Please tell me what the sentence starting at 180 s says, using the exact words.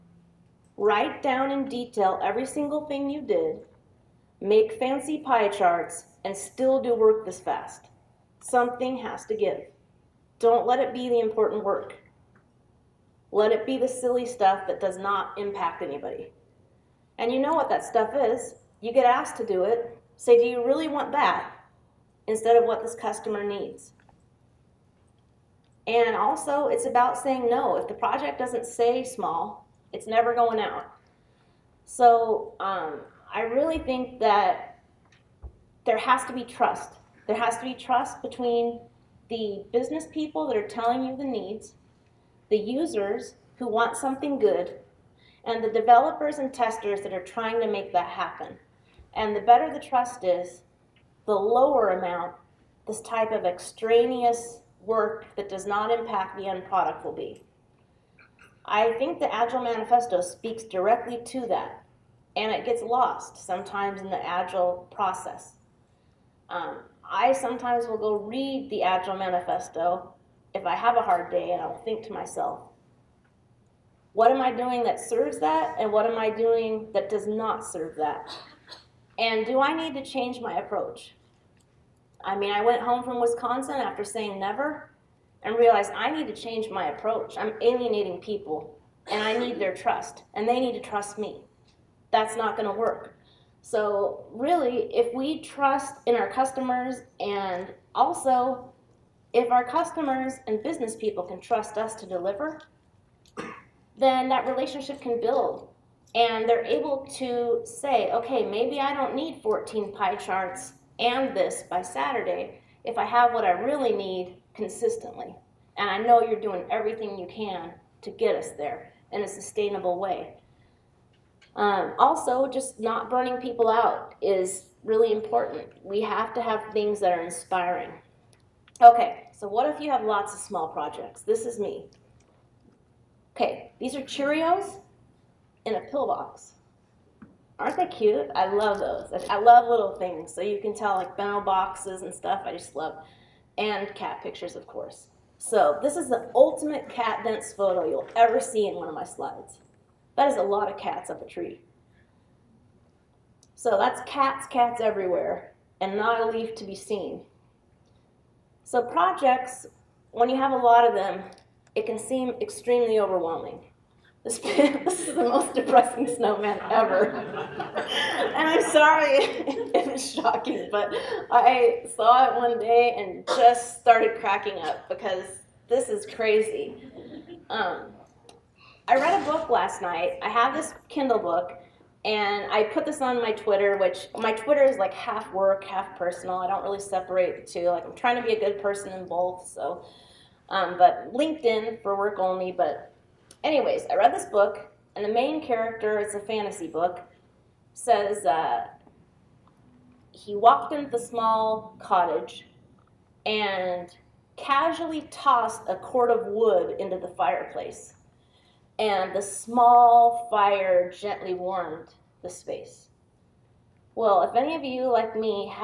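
I have this Kindle book, and I put this on my Twitter, which my Twitter is like half work, half personal.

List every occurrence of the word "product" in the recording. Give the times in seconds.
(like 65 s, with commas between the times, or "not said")
56 s.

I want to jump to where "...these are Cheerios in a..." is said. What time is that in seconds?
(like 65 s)
133 s.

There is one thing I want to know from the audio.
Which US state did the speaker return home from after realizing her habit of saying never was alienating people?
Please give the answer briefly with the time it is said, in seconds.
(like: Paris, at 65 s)
Wisconsin, at 83 s.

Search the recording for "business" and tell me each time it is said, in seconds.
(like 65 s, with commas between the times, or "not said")
39 s, 100 s.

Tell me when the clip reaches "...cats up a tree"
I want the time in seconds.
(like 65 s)
150 s.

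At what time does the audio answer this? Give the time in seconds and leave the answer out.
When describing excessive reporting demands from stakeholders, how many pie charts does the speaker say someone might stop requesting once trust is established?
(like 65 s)
109 s.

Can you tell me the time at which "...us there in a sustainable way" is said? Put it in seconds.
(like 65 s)
118 s.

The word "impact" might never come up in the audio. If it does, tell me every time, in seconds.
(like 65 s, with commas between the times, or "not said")
15 s, 55 s.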